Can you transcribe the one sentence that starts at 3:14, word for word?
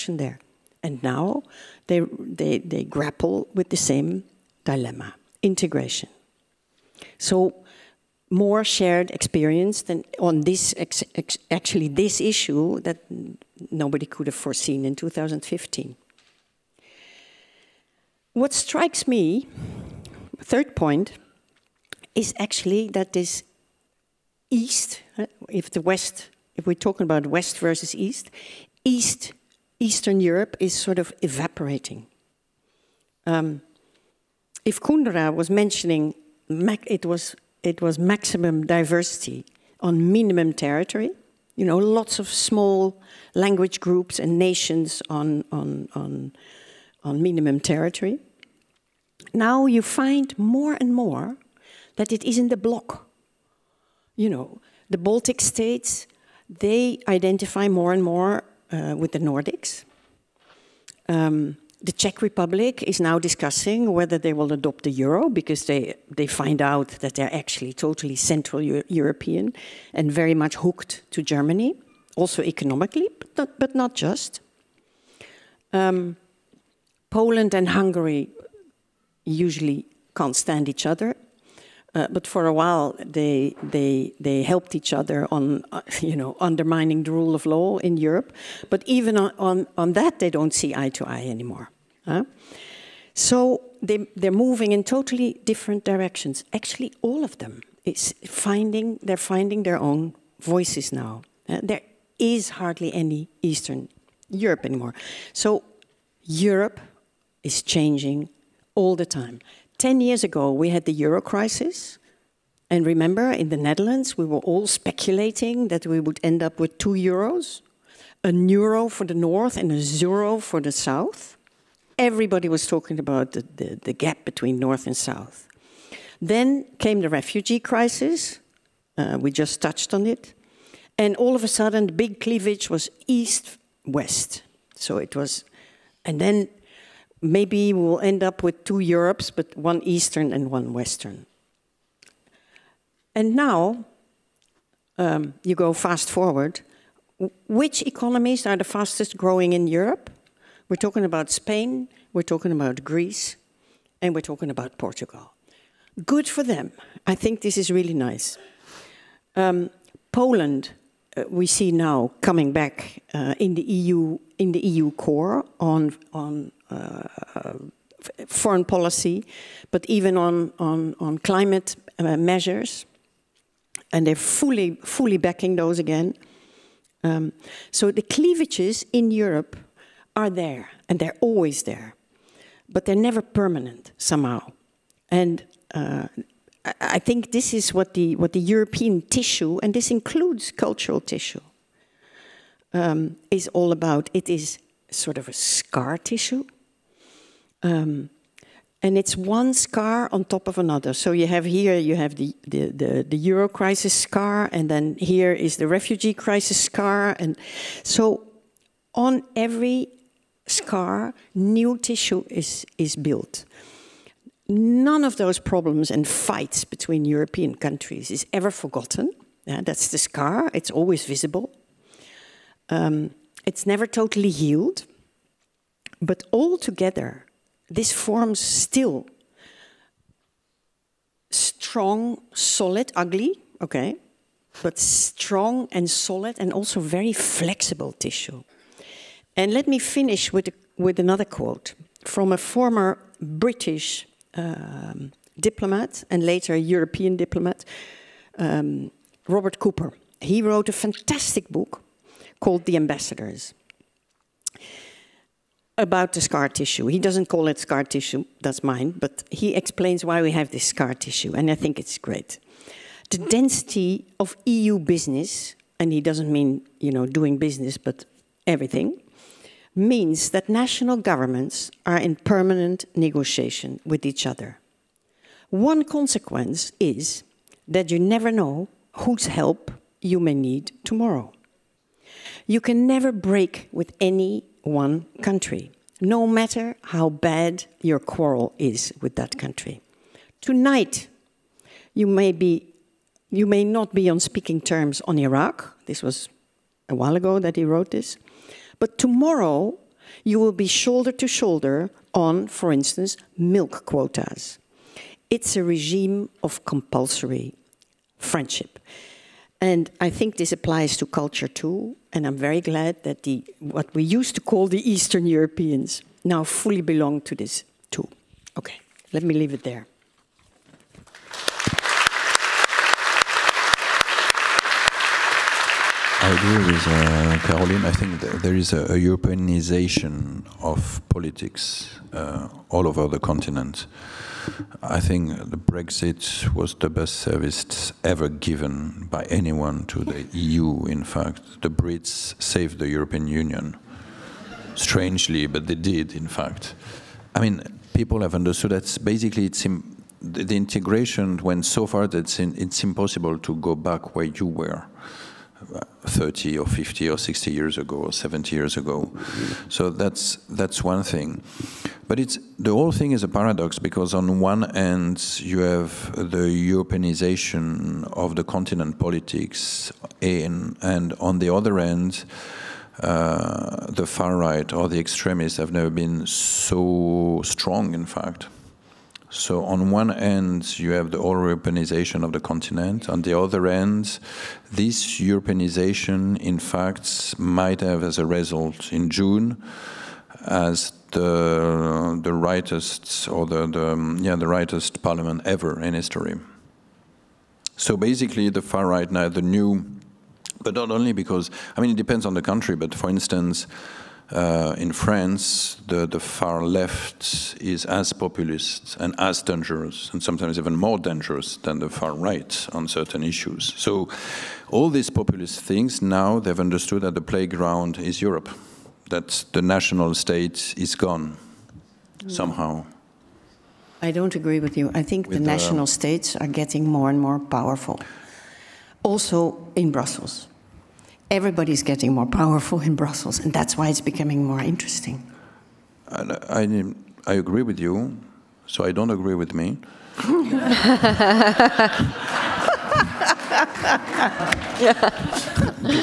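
It is sort of a scar tissue um, and it's one scar on top of another.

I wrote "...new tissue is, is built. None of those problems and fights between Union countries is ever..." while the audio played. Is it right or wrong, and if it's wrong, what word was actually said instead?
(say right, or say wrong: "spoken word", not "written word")
wrong: "European", not "Union".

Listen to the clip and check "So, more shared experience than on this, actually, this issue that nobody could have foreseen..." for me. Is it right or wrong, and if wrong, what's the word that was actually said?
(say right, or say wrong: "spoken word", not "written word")
right.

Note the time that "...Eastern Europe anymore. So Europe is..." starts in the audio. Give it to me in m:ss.
1:43.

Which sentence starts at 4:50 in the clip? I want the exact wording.
Tonight, you may be you may not be on speaking terms on Iraq.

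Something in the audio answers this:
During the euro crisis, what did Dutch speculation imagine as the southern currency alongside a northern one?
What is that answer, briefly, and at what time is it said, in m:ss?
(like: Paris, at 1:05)
a zero, at 1:59.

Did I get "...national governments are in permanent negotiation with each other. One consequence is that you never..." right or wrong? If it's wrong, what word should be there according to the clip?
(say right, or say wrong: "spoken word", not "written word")
right.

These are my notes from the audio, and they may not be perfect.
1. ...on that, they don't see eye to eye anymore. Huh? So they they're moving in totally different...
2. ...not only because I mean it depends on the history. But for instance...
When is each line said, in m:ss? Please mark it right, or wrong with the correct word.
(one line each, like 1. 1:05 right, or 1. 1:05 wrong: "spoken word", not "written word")
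1. 1:29 right
2. 6:40 wrong: "country", not "history".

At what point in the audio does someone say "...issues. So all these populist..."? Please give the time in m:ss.
6:53.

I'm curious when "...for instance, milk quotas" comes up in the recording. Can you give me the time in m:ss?
5:02.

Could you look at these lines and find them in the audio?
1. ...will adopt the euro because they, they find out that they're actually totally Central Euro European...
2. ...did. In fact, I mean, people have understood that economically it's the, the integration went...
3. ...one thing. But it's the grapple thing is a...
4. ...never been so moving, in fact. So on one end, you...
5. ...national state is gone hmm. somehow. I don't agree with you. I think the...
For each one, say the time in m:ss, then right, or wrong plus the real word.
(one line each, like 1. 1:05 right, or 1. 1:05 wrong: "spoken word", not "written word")
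1. 1:04 right
2. 5:45 wrong: "basically", not "economically"
3. 6:00 wrong: "whole", not "grapple"
4. 6:15 wrong: "strong", not "moving"
5. 6:59 right.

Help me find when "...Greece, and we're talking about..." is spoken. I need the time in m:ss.
2:32.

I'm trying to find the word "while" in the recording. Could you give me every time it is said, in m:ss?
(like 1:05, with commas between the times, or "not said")
1:22, 4:56.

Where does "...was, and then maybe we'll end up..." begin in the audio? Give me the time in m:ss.
2:15.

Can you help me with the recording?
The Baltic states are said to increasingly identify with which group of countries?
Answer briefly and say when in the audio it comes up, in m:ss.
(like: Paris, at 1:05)
the Nordics, at 0:59.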